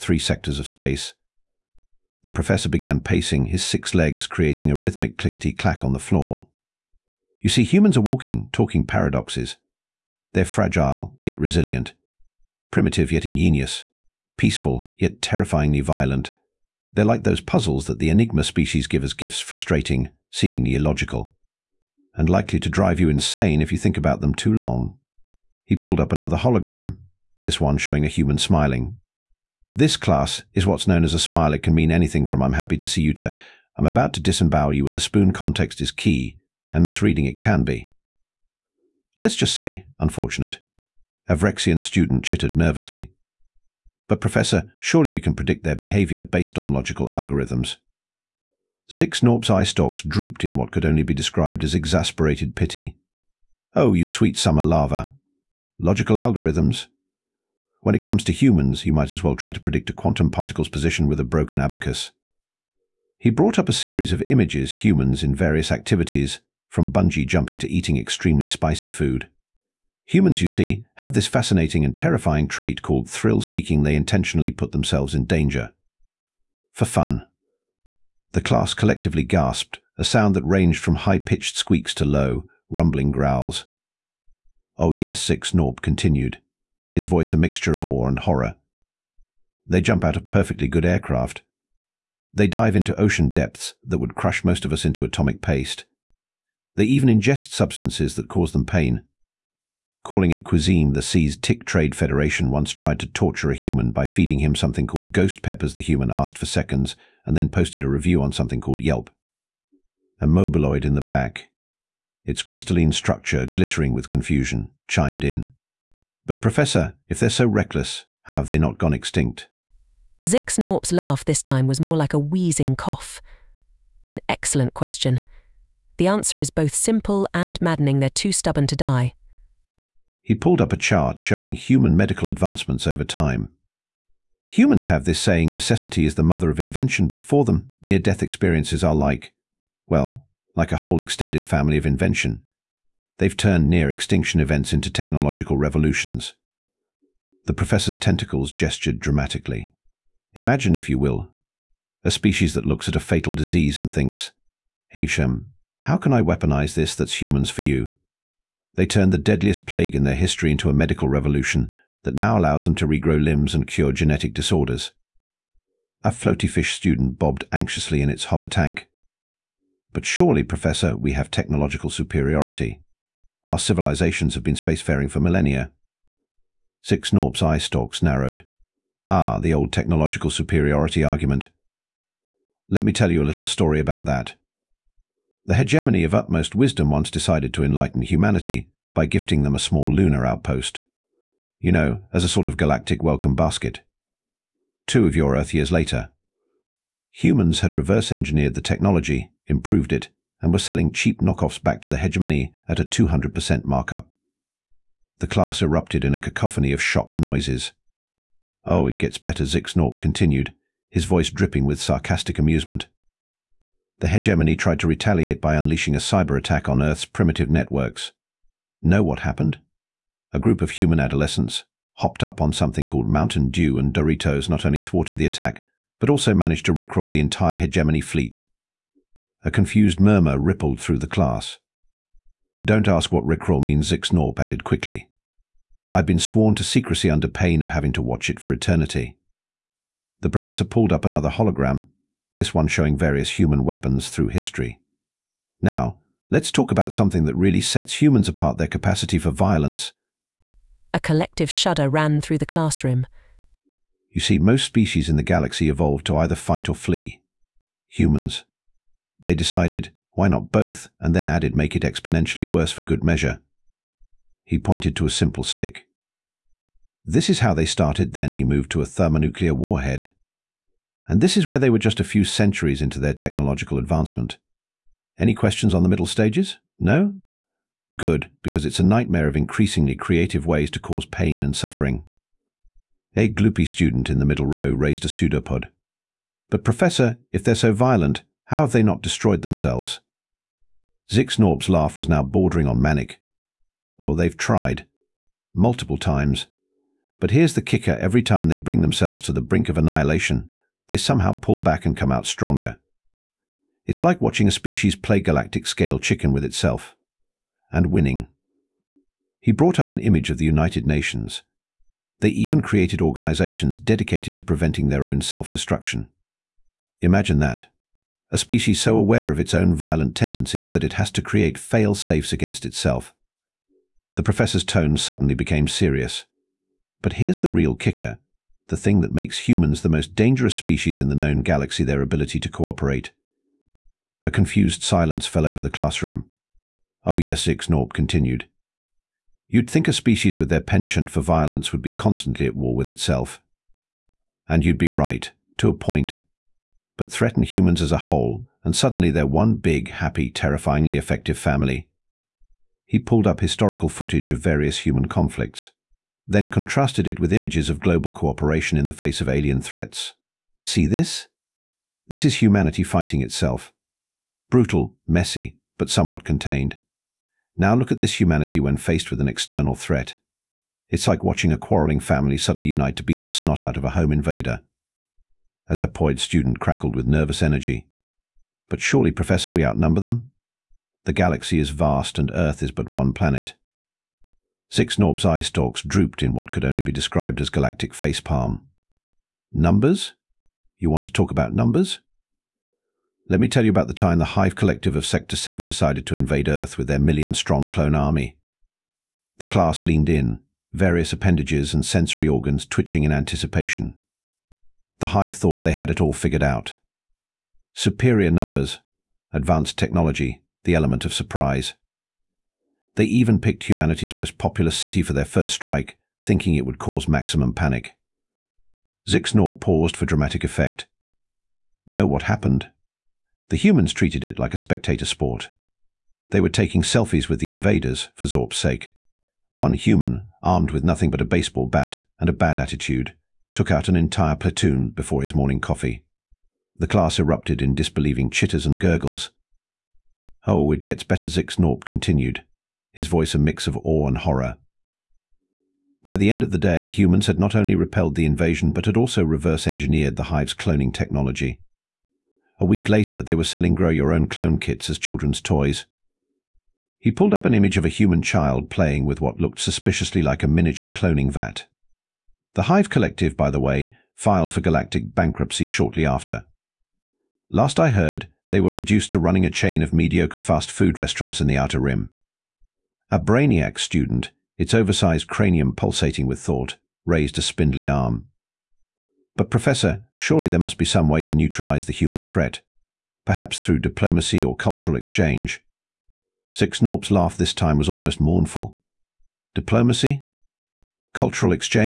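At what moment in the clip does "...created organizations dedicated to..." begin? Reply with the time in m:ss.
5:12.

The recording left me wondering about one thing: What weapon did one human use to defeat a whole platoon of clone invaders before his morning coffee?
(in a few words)
baseball bat.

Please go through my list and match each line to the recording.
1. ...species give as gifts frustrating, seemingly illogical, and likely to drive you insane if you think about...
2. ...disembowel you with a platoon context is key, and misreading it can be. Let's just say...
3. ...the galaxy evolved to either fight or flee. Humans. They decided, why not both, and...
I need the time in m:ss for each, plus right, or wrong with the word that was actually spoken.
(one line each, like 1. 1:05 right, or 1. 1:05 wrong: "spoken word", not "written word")
1. 0:18 right
2. 0:34 wrong: "spoon", not "platoon"
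3. 4:15 right.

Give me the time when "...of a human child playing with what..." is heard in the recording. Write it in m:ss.
7:37.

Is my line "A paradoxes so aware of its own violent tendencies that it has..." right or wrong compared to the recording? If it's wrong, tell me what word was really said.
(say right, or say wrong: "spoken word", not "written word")
wrong: "species", not "paradoxes".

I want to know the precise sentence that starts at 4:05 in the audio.
Now, let's talk about something that really sets humans apart their capacity for violence.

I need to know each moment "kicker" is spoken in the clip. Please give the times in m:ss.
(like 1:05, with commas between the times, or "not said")
4:57, 5:27.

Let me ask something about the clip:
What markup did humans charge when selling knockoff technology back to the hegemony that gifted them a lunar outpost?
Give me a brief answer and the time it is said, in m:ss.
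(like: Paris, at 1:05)
200%, at 3:22.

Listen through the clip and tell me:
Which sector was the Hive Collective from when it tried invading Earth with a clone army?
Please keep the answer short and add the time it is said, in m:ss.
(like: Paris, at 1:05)
Sector 7, at 6:35.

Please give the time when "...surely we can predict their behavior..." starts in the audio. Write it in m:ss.
0:44.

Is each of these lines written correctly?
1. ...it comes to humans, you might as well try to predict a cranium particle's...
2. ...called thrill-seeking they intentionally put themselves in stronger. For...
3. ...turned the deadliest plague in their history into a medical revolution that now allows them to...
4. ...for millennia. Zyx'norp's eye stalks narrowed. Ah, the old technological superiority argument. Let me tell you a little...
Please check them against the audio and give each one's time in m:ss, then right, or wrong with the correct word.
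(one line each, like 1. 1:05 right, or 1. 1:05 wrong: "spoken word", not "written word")
1. 0:57 wrong: "quantum", not "cranium"
2. 1:12 wrong: "danger", not "stronger"
3. 2:38 right
4. 2:55 right.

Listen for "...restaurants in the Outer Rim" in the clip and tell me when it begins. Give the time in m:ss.
7:50.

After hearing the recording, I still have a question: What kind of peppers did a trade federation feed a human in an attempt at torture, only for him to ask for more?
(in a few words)
ghost peppers.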